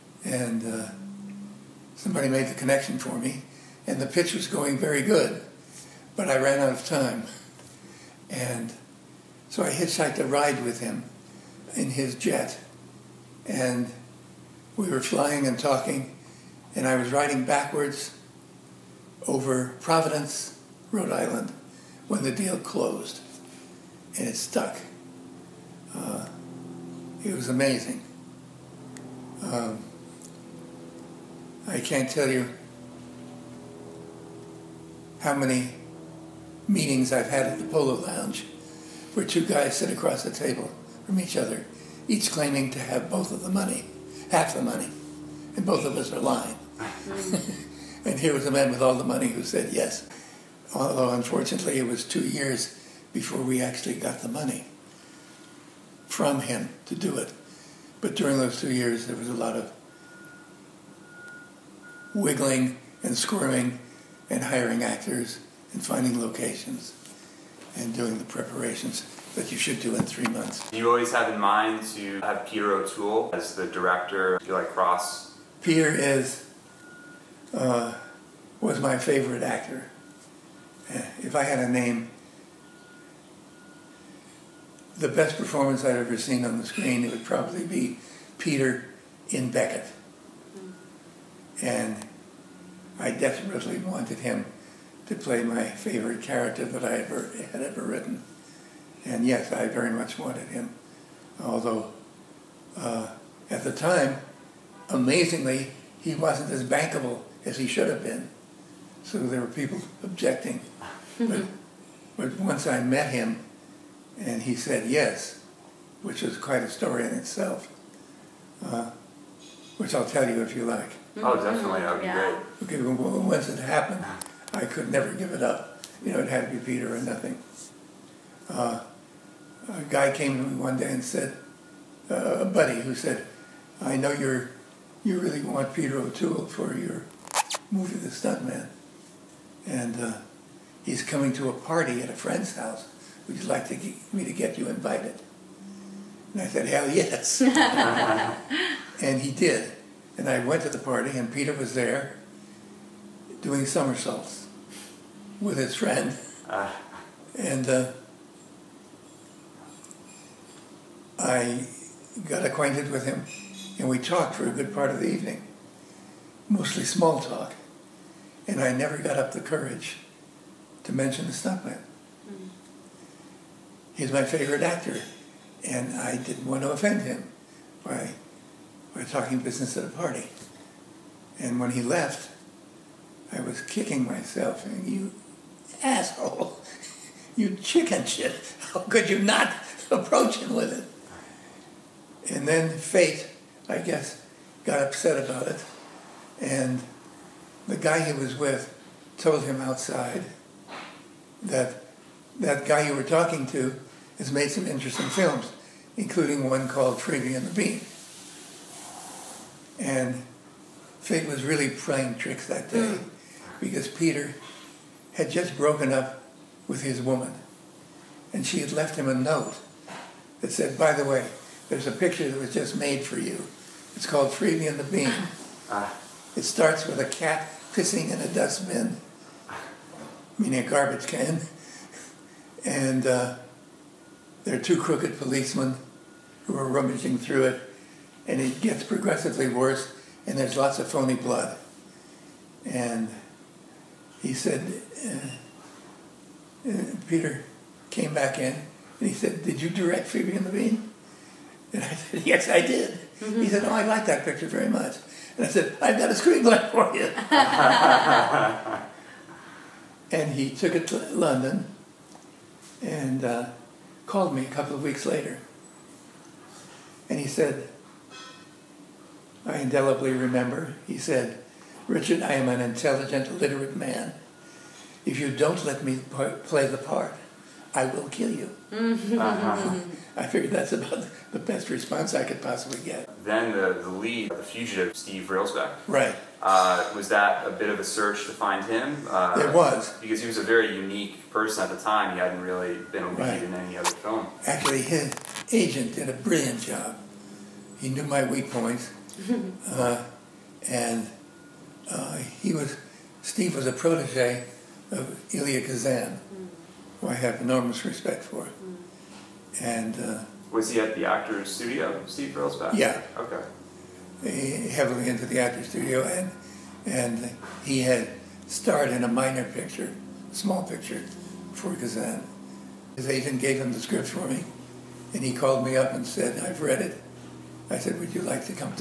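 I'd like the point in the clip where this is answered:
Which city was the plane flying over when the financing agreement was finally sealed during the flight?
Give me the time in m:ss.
0:19.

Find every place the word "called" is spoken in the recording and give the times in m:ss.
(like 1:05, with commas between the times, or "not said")
3:26, 3:44, 4:24, 5:25.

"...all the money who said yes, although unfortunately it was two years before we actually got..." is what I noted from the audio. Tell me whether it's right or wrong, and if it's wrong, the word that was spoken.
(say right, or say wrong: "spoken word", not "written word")
right.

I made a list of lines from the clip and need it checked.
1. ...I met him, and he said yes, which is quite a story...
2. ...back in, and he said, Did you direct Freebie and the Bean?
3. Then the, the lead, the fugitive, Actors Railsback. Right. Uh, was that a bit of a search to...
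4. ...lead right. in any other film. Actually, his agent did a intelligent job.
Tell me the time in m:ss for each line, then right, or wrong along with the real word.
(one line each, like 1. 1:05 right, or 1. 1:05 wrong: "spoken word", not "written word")
1. 1:52 right
2. 4:08 right
3. 4:43 wrong: "Steve", not "Actors"
4. 4:53 wrong: "brilliant", not "intelligent".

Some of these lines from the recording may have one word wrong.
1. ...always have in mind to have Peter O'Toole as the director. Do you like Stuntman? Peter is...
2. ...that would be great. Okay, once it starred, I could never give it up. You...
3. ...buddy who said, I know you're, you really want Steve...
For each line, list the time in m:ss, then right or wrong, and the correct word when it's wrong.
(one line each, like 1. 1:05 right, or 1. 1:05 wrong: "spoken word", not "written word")
1. 1:10 wrong: "Cross", not "Stuntman"
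2. 2:01 wrong: "happened", not "starred"
3. 2:12 wrong: "Peter", not "Steve".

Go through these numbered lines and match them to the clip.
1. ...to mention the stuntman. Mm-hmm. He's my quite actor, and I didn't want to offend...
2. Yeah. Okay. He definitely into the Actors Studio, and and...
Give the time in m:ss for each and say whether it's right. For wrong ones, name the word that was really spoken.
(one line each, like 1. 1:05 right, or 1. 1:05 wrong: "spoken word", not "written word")
1. 2:50 wrong: "favorite", not "quite"
2. 5:12 wrong: "heavily", not "definitely".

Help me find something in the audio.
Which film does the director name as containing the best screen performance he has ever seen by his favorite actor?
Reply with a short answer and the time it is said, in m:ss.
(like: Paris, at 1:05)
Becket, at 1:29.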